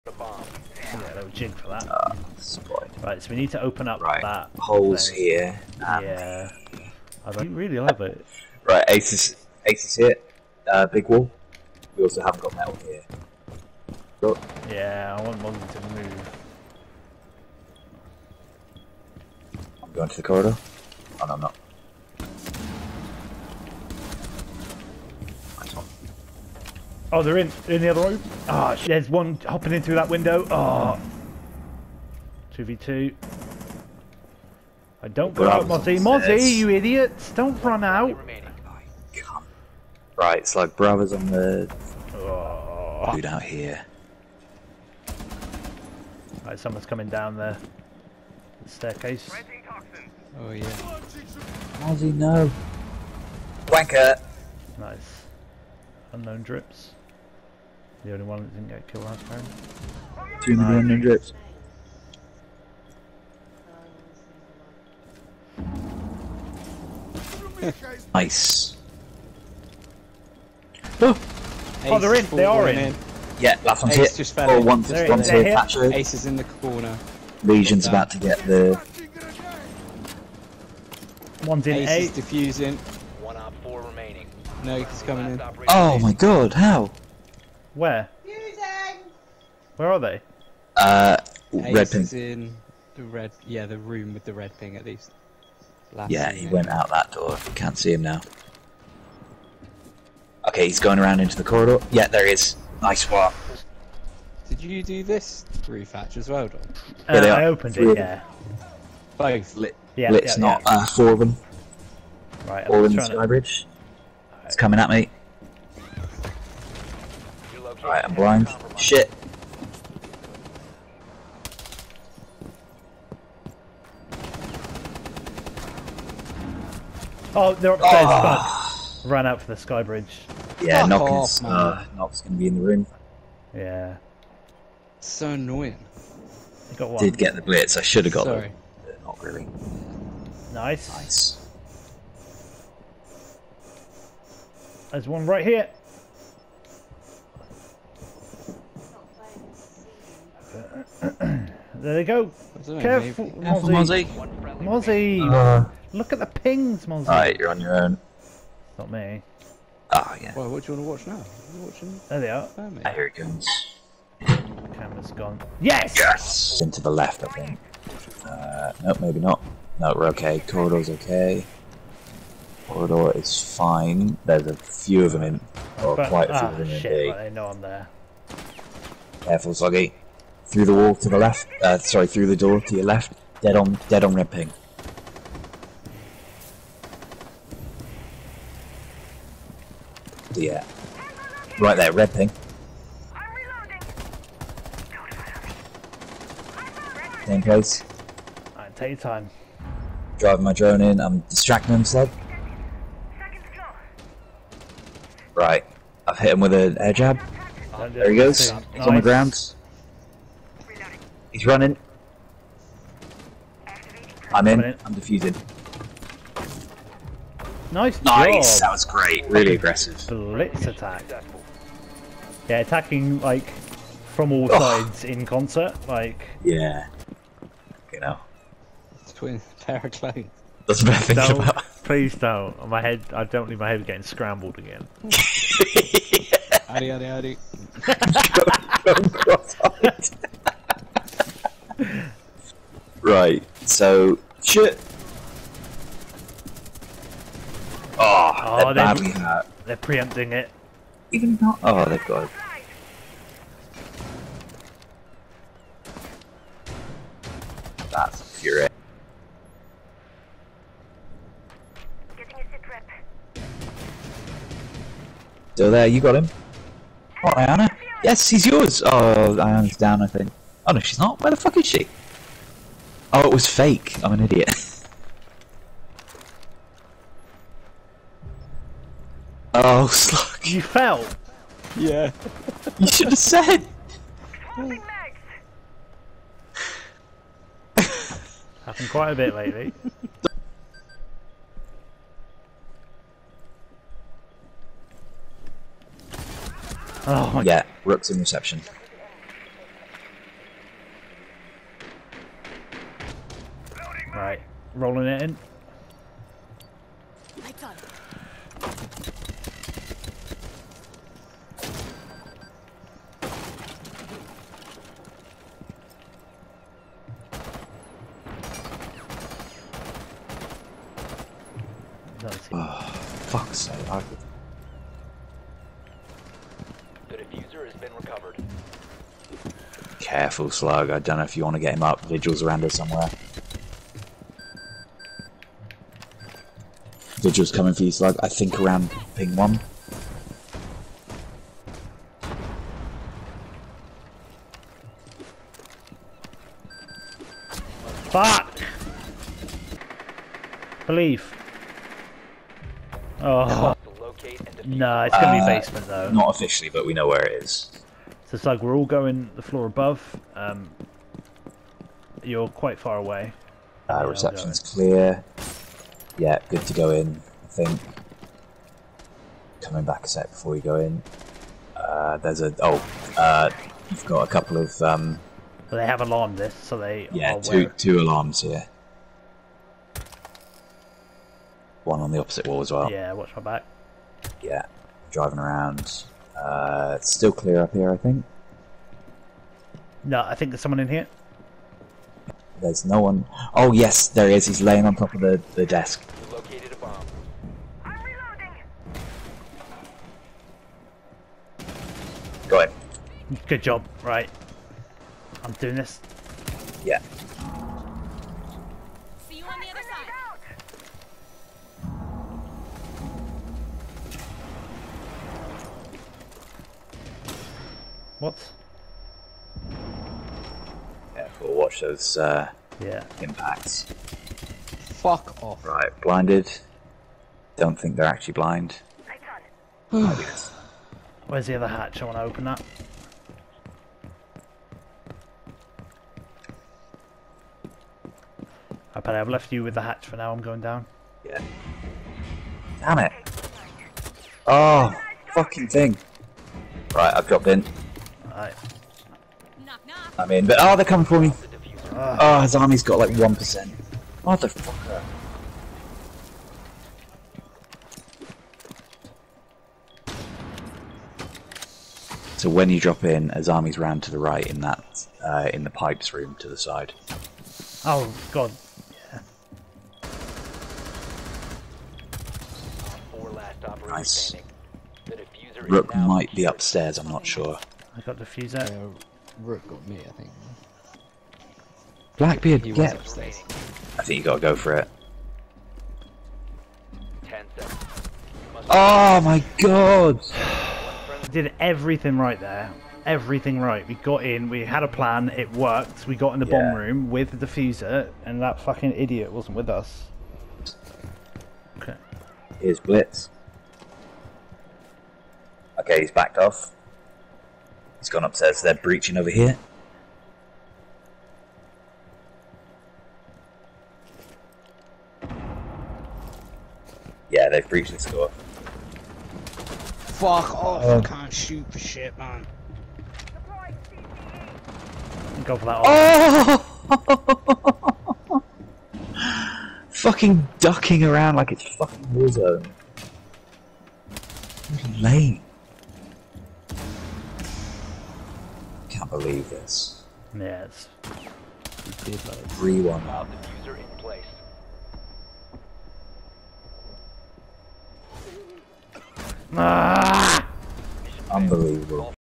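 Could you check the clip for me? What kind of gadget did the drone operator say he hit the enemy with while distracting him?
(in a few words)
Air jab.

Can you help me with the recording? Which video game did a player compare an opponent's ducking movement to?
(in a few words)
Warzone.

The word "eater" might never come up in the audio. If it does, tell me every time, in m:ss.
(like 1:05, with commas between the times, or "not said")
not said.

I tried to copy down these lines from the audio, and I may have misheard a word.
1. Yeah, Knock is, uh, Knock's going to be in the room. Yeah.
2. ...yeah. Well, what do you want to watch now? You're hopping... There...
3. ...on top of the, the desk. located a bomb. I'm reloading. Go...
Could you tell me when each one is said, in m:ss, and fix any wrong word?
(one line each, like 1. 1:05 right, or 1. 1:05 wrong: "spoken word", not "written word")
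1. 2:10 right
2. 2:40 wrong: "watching", not "hopping"
3. 6:34 right.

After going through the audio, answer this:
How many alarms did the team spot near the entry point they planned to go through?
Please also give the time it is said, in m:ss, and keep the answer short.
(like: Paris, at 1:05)
2, at 6:17.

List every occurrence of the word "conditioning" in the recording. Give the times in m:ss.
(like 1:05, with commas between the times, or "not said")
not said.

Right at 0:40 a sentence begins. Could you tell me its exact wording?
Right, it's like brothers on the...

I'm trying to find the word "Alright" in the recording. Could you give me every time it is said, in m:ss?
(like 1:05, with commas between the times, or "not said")
2:37, 3:18.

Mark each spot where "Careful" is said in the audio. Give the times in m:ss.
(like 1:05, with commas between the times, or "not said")
2:32, 2:59, 5:29.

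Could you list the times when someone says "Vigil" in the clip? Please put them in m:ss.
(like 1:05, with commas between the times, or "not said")
5:32, 5:37.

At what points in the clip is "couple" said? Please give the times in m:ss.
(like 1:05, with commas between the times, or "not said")
6:14.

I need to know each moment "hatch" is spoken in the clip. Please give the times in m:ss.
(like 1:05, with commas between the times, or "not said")
1:45, 7:11, 7:19.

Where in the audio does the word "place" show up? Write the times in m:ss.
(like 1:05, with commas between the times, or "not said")
3:17, 9:03.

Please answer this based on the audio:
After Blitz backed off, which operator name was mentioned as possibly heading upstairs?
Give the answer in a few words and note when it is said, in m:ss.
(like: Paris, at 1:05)
Blackbeard, at 8:02.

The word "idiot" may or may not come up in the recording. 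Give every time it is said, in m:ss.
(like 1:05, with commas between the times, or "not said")
0:36, 4:34, 8:18.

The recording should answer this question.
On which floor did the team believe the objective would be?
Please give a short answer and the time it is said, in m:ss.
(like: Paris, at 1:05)
Basement, at 5:55.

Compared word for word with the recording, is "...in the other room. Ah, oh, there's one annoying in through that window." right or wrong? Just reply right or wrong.
wrong.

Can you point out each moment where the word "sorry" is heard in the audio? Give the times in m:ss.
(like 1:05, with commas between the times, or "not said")
2:18, 3:01.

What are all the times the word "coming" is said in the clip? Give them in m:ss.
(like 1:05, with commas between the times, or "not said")
0:46, 1:25, 1:54, 5:37, 6:09, 7:30.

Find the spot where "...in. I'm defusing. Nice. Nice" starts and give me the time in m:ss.
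3:34.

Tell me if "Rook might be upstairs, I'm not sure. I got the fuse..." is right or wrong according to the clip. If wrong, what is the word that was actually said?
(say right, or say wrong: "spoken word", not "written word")
right.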